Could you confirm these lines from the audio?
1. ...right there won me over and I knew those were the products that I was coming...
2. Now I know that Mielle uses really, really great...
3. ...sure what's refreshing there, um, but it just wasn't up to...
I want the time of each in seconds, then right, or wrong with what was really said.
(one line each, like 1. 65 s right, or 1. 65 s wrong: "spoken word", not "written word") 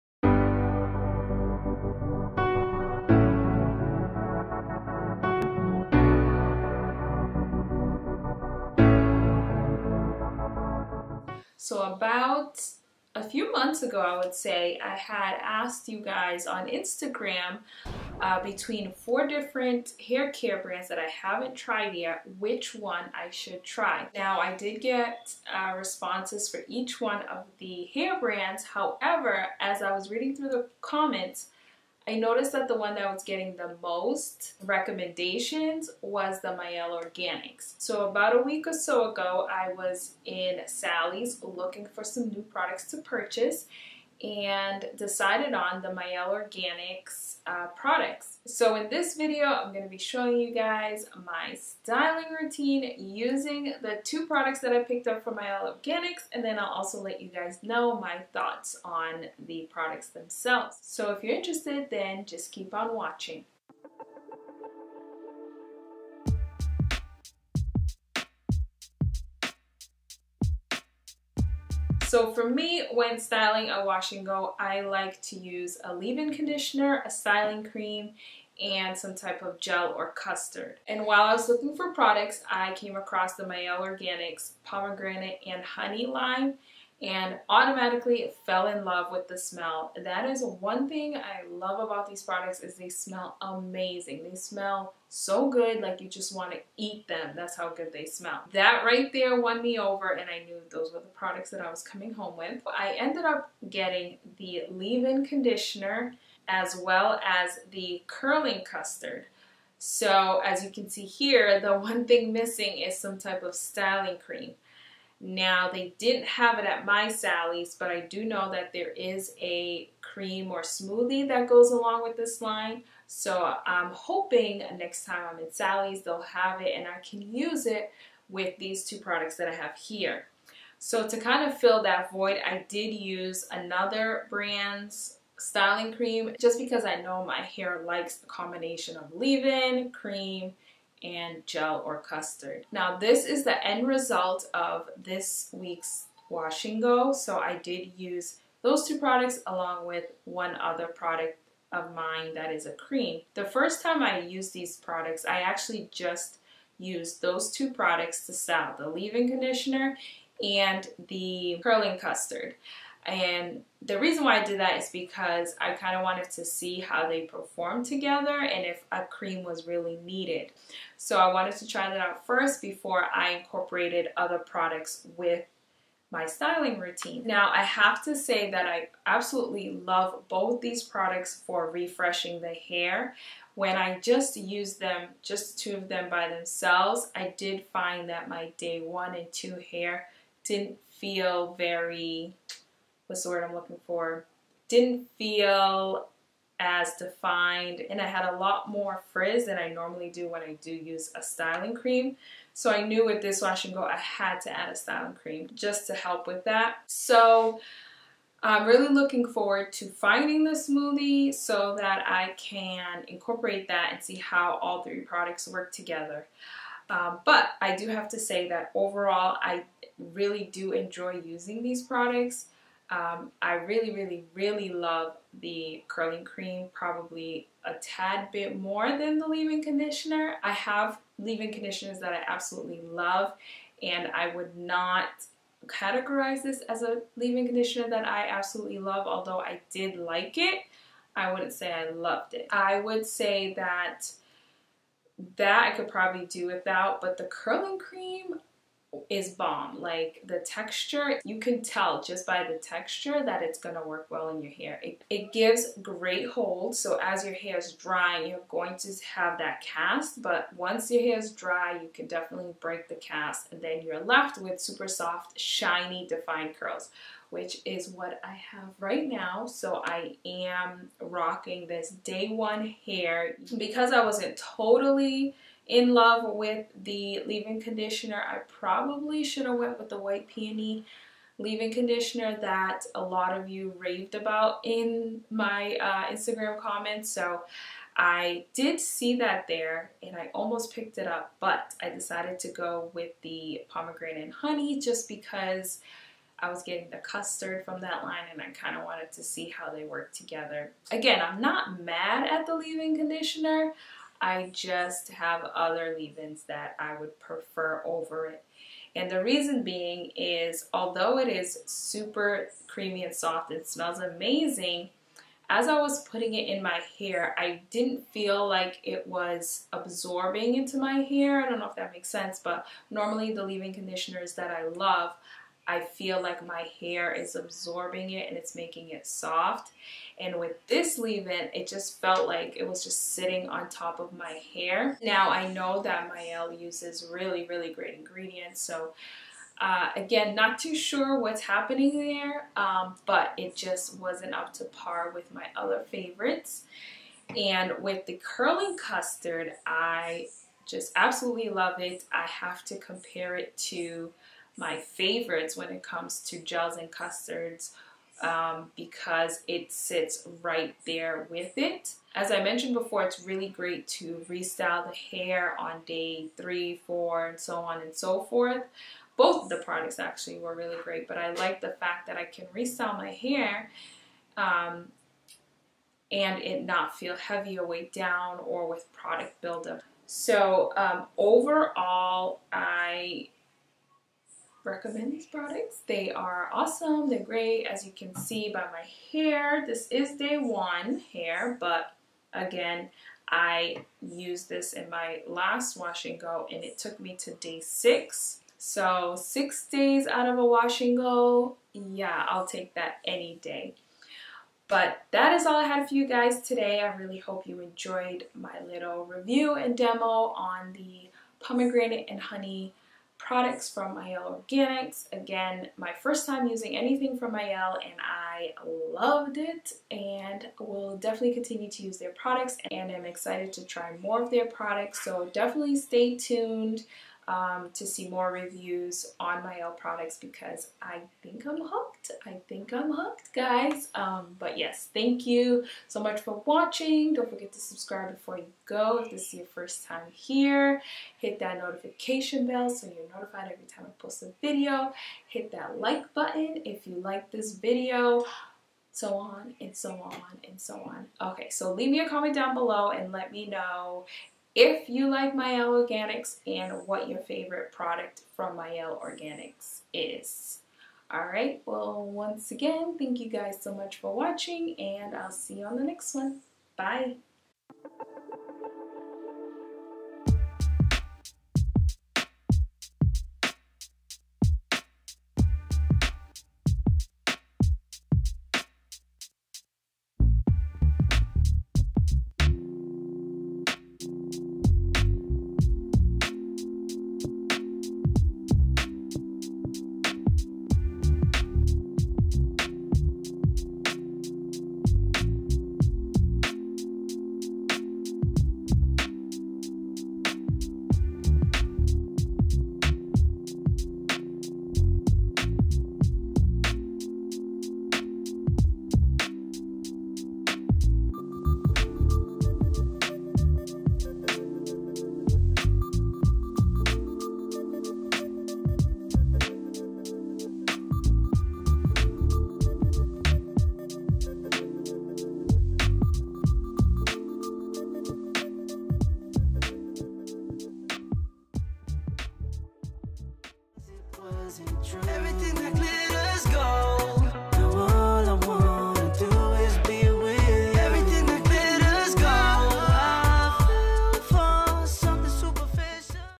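1. 98 s right
2. 335 s right
3. 340 s wrong: "happening", not "refreshing".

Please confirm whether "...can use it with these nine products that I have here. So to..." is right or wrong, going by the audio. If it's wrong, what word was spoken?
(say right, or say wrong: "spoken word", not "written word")
wrong: "two", not "nine".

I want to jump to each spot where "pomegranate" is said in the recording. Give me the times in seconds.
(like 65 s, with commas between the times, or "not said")
84 s, 293 s, 411 s.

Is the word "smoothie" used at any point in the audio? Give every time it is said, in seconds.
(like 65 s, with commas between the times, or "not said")
120 s, 210 s.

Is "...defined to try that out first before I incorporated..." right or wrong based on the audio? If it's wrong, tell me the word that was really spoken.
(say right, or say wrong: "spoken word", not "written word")
wrong: "wanted", not "defined".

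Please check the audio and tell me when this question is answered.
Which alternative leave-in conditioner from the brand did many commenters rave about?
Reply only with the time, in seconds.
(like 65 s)
279 s.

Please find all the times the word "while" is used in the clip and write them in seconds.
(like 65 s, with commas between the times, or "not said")
81 s.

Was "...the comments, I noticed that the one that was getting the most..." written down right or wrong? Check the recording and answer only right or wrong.
right.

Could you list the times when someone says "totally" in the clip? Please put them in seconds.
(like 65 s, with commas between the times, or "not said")
274 s.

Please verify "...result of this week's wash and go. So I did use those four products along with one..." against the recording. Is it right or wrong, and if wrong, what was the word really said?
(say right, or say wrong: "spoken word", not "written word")
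wrong: "two", not "four".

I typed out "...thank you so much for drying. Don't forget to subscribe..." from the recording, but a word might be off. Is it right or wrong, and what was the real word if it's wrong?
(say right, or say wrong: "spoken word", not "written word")
wrong: "watching", not "drying".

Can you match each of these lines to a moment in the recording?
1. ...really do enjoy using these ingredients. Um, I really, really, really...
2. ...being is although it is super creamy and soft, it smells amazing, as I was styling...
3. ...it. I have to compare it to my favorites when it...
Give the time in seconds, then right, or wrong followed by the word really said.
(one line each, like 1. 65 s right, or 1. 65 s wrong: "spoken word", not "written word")
1. 219 s wrong: "products", not "ingredients"
2. 309 s wrong: "putting", not "styling"
3. 351 s right.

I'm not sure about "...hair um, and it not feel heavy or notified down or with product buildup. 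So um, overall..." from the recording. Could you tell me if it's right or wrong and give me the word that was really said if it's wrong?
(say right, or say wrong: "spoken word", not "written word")
wrong: "weighed", not "notified".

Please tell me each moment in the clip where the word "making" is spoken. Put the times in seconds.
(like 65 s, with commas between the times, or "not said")
328 s.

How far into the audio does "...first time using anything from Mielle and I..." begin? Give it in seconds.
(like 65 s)
416 s.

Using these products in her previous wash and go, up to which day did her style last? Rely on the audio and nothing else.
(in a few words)
day 6.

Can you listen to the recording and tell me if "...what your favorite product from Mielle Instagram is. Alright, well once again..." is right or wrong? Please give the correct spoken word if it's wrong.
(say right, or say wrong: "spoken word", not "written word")
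wrong: "Organics", not "Instagram".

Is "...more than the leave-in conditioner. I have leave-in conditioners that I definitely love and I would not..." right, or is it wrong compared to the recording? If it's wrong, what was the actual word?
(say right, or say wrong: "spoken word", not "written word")
wrong: "absolutely", not "definitely".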